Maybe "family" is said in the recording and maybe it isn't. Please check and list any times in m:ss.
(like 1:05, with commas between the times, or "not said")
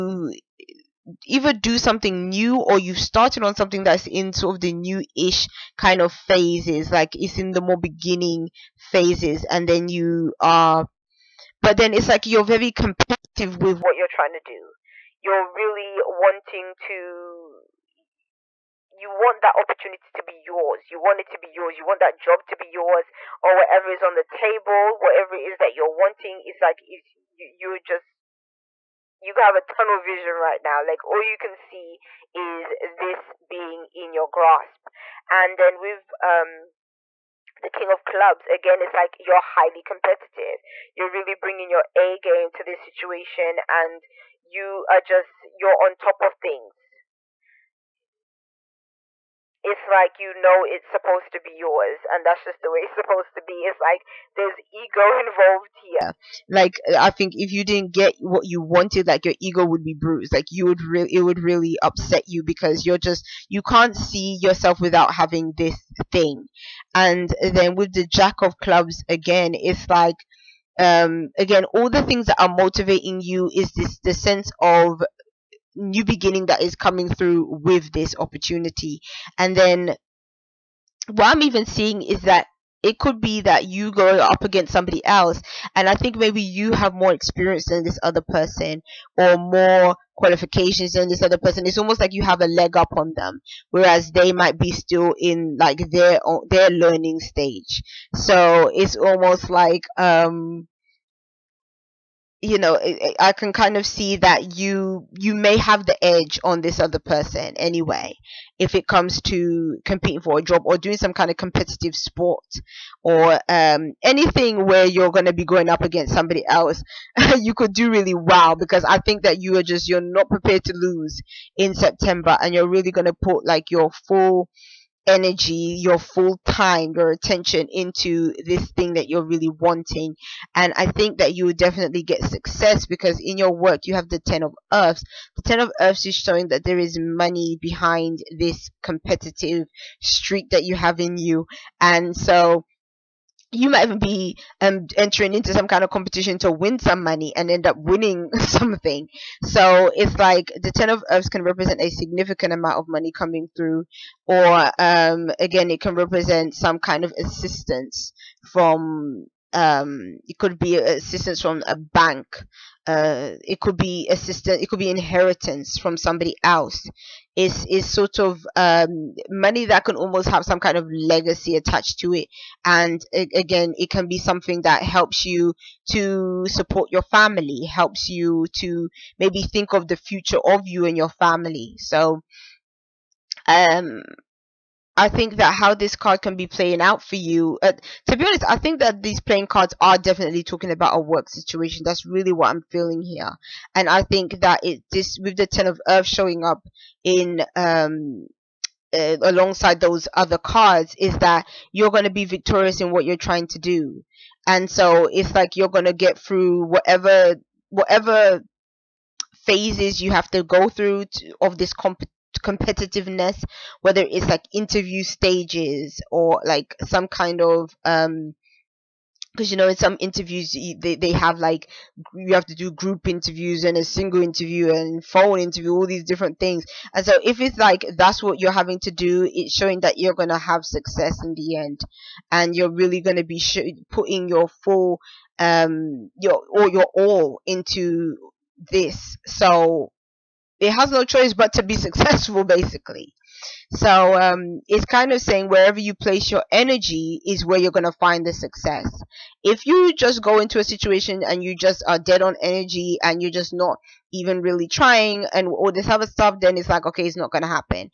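2:57, 3:01.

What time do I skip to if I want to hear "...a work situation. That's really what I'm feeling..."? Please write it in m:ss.
3:10.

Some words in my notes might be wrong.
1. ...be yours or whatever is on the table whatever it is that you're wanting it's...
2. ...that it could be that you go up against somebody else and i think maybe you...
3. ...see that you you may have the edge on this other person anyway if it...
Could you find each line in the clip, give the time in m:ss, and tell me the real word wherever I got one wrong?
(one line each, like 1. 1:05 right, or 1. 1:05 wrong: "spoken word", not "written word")
1. 0:22 right
2. 1:22 right
3. 1:43 right.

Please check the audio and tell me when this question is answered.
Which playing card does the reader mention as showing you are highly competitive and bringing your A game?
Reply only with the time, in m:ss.
0:37.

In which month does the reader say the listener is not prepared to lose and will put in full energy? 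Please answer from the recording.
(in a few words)
September.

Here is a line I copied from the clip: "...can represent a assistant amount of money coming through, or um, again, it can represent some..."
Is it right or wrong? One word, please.
wrong.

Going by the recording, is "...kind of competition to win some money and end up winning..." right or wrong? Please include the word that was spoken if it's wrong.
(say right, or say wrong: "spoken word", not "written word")
right.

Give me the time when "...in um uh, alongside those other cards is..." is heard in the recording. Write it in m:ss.
3:17.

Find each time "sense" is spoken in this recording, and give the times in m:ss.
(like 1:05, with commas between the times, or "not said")
1:14.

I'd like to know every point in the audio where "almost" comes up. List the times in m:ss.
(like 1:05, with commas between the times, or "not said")
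1:31, 1:38, 2:49.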